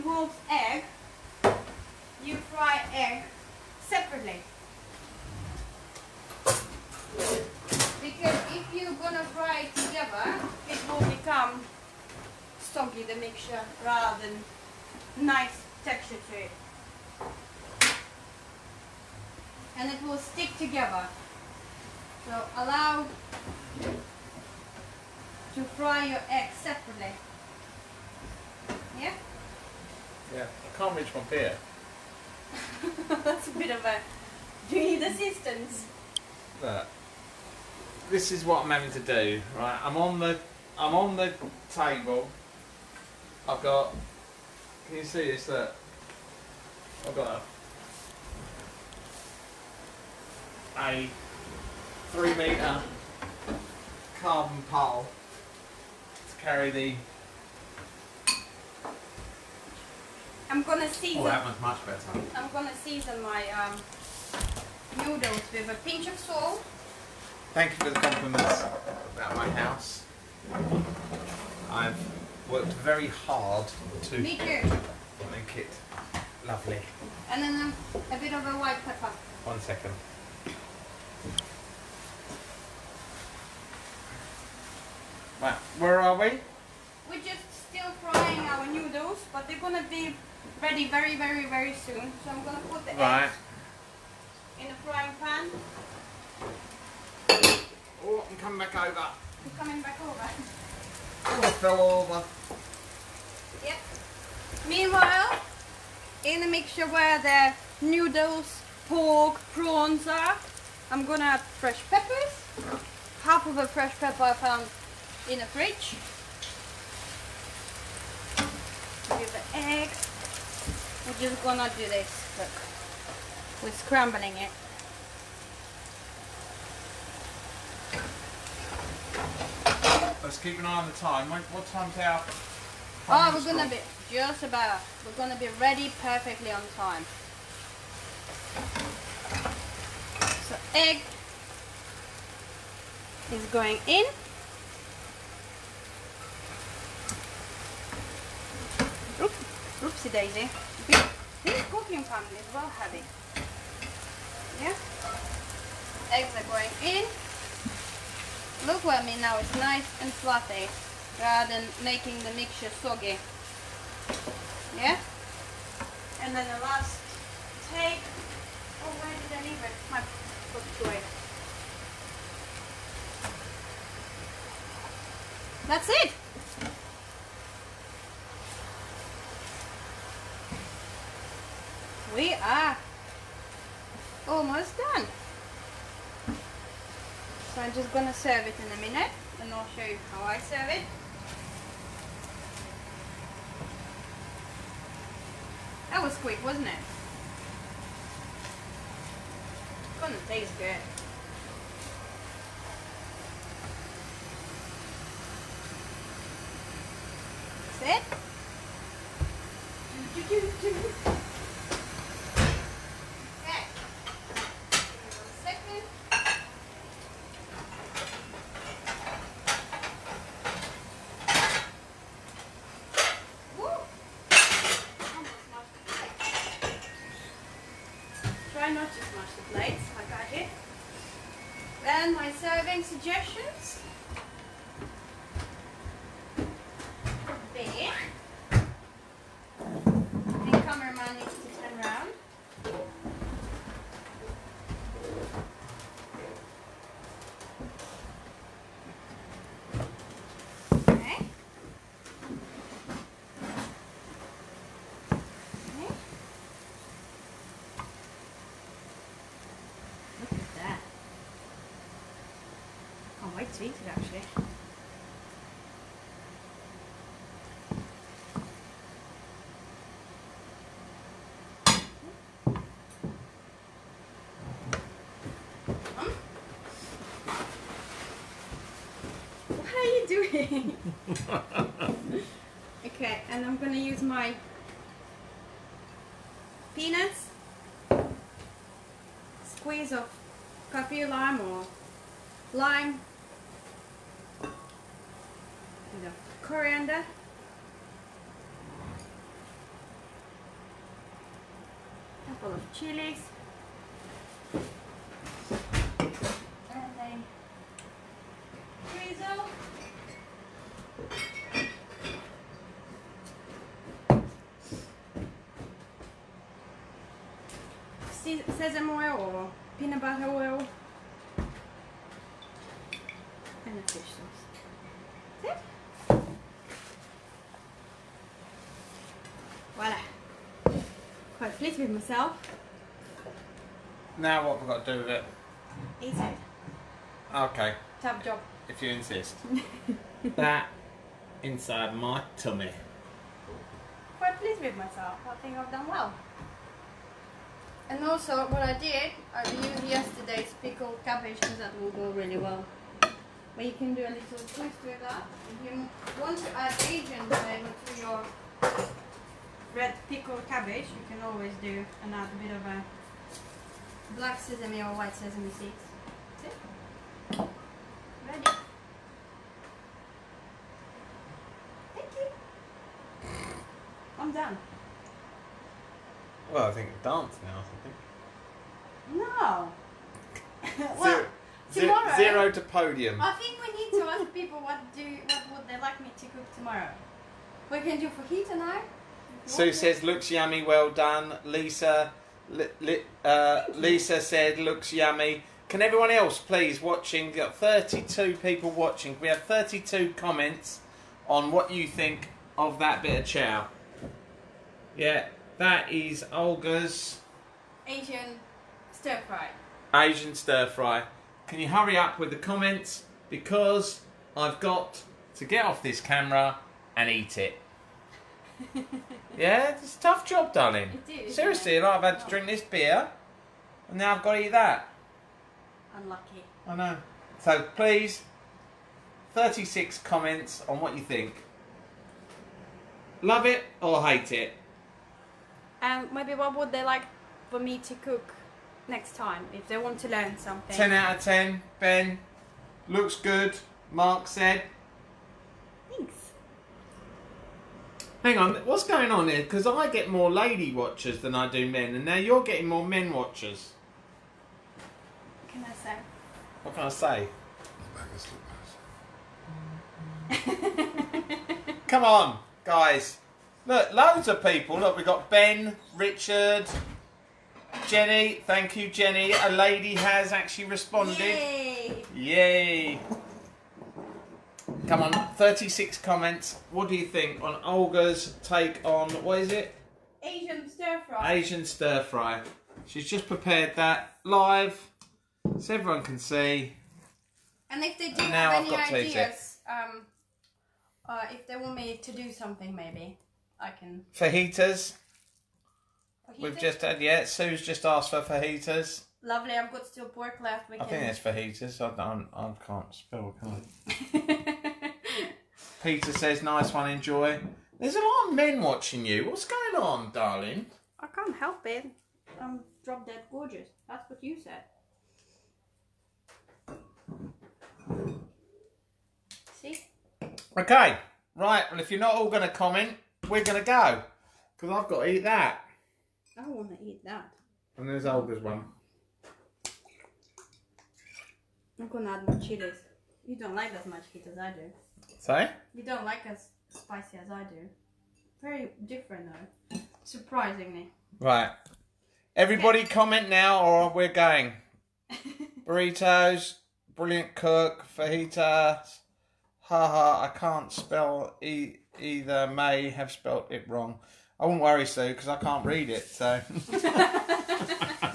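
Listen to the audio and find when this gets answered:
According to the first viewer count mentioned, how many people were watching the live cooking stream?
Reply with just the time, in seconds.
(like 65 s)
397 s.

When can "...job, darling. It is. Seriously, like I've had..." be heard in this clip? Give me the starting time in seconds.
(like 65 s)
420 s.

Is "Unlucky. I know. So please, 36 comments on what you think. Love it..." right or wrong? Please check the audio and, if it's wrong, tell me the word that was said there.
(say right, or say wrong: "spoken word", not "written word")
right.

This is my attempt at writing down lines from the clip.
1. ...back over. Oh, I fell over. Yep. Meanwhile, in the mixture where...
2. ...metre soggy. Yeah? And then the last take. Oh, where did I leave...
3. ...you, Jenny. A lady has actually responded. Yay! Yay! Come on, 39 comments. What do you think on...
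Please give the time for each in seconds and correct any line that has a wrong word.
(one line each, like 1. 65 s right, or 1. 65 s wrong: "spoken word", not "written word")
1. 99 s right
2. 162 s wrong: "mixture", not "metre"
3. 468 s wrong: "36", not "39".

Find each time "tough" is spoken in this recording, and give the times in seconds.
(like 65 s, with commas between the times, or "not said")
420 s.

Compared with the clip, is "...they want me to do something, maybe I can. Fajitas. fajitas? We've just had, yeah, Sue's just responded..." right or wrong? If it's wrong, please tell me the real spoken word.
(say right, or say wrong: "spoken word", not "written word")
wrong: "asked", not "responded".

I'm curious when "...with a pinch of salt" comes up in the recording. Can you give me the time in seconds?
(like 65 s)
65 s.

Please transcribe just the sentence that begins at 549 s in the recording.
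Haha, I can't spell e either.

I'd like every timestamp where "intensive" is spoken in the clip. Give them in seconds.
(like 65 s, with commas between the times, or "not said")
not said.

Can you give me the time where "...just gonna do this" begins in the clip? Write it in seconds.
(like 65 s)
121 s.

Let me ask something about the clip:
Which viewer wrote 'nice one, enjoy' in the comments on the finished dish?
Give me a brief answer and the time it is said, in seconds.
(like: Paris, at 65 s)
Peter, at 505 s.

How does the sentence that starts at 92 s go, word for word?
So I'm gonna put the right.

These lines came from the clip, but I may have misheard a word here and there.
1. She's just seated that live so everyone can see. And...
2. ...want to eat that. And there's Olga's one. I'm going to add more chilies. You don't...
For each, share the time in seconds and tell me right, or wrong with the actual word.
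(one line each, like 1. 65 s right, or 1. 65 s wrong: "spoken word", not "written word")
1. 482 s wrong: "prepared", not "seated"
2. 526 s right.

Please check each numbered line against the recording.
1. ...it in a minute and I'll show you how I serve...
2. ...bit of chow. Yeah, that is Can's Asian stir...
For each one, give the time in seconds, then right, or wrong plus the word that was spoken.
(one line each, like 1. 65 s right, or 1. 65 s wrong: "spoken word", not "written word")
1. 188 s right
2. 403 s wrong: "Olga", not "Can".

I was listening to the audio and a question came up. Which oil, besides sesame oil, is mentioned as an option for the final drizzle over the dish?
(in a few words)
Peanut butter oil.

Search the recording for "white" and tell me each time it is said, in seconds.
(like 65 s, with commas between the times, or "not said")
78 s, 364 s.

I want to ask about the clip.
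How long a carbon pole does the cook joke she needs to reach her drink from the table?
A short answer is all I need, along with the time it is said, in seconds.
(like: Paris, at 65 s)
3 metres, at 52 s.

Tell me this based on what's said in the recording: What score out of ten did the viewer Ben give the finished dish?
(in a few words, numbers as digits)
10 out of 10.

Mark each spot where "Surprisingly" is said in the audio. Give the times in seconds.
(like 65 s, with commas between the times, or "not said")
540 s.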